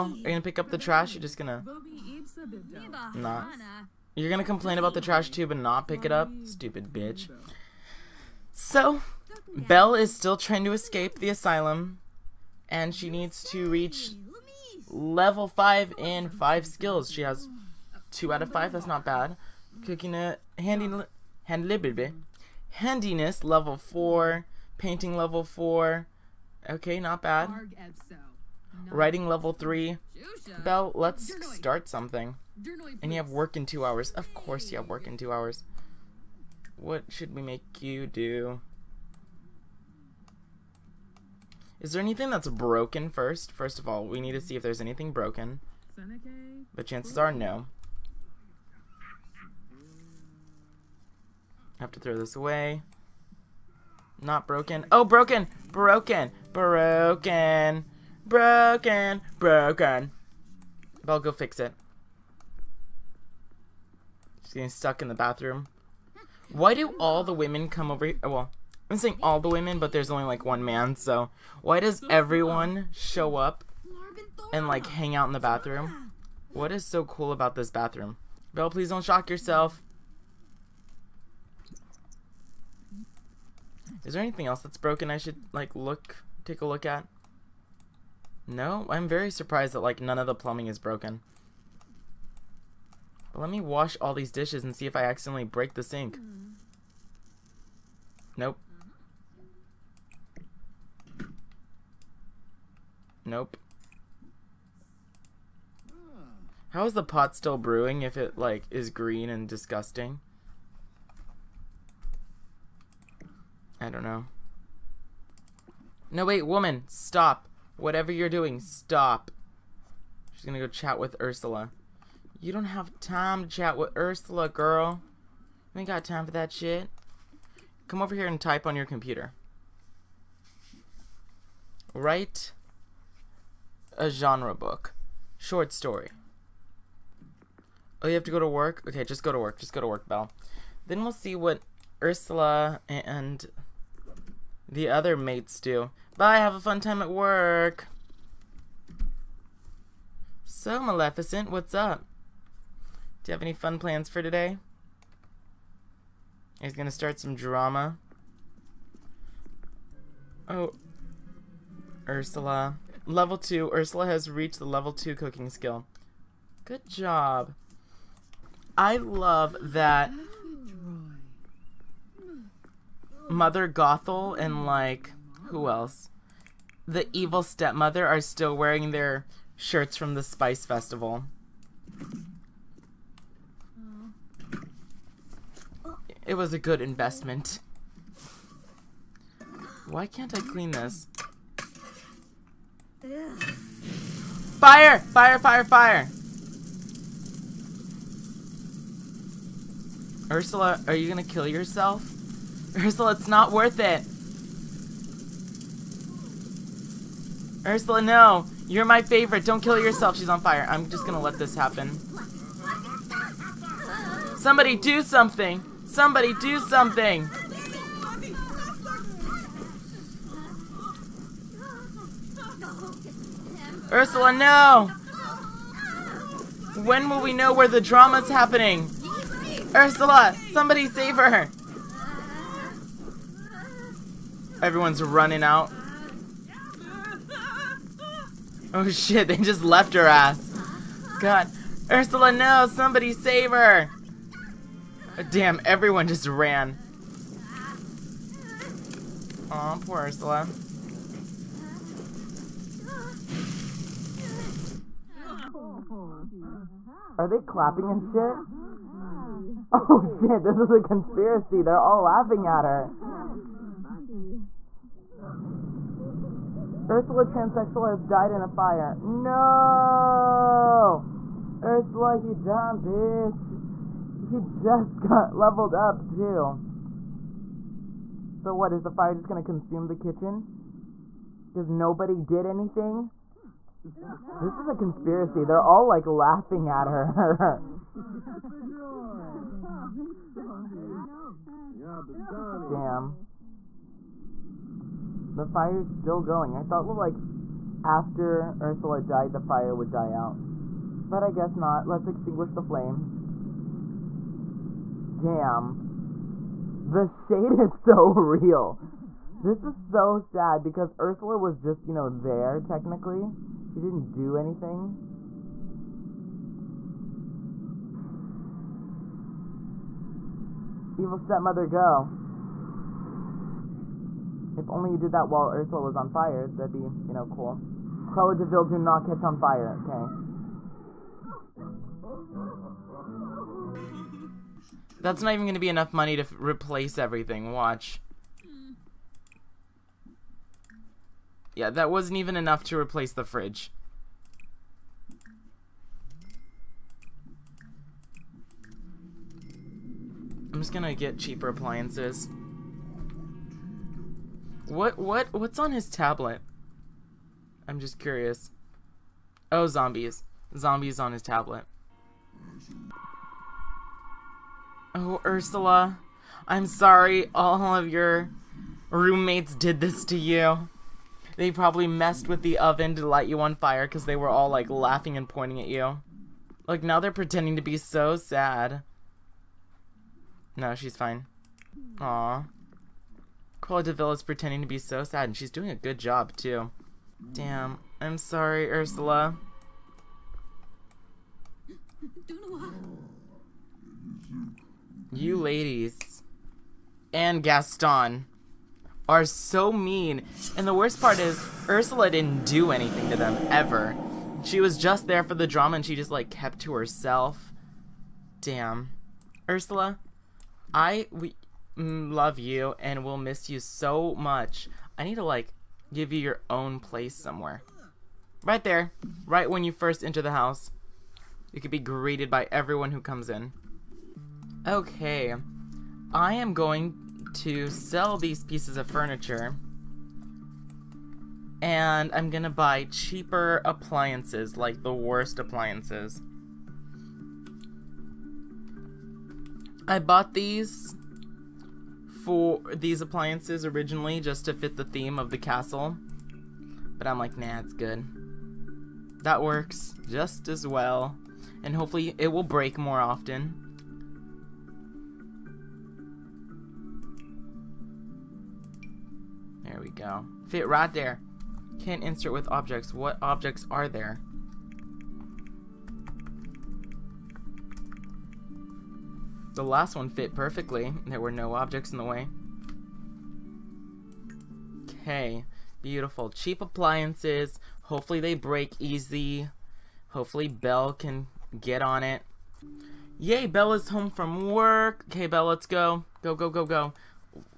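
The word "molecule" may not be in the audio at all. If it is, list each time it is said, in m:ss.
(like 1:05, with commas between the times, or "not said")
not said.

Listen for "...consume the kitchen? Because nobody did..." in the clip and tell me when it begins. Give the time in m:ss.
4:39.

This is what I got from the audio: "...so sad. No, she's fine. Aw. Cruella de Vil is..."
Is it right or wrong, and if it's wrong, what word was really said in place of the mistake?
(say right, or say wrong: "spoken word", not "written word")
right.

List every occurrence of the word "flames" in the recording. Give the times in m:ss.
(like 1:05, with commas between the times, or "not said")
5:02.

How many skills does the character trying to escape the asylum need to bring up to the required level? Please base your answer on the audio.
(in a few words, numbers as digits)
5.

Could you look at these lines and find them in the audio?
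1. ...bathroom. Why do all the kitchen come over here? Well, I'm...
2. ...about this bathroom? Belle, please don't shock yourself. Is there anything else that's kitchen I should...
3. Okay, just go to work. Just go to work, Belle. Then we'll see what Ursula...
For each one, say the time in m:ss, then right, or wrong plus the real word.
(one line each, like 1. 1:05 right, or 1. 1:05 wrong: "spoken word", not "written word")
1. 1:05 wrong: "women", not "kitchen"
2. 1:17 wrong: "broken", not "kitchen"
3. 2:18 right.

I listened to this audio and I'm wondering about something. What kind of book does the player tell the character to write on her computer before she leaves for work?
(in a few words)
Genre book.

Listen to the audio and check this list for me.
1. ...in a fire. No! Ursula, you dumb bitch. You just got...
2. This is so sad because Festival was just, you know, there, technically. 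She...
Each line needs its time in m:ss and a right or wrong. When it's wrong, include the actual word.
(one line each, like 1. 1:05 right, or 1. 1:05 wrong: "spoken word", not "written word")
1. 4:28 right
2. 5:09 wrong: "Ursula", not "Festival".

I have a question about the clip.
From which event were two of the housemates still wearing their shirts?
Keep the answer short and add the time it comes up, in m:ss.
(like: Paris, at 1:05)
Spice Festival, at 3:00.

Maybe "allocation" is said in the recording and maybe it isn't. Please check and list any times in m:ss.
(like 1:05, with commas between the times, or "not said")
not said.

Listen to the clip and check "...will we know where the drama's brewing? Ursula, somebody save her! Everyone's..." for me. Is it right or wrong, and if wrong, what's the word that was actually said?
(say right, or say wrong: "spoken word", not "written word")
wrong: "happening", not "brewing".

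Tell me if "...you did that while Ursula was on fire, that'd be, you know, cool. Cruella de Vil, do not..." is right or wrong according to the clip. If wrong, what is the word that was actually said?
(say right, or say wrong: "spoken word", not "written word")
right.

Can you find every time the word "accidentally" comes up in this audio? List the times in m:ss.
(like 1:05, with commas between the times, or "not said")
1:35.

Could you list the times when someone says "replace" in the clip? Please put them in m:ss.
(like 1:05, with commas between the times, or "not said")
5:36, 5:42.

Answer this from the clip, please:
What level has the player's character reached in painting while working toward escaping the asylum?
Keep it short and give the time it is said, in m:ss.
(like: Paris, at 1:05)
level 4, at 0:24.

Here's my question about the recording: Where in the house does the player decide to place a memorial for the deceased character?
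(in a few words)
Right when you first enter.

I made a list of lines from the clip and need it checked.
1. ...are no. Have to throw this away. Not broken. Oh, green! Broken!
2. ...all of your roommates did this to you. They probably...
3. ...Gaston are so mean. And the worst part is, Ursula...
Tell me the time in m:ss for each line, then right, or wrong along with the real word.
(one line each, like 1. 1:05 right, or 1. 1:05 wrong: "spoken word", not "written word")
1. 0:47 wrong: "broken", not "green"
2. 6:07 right
3. 6:37 right.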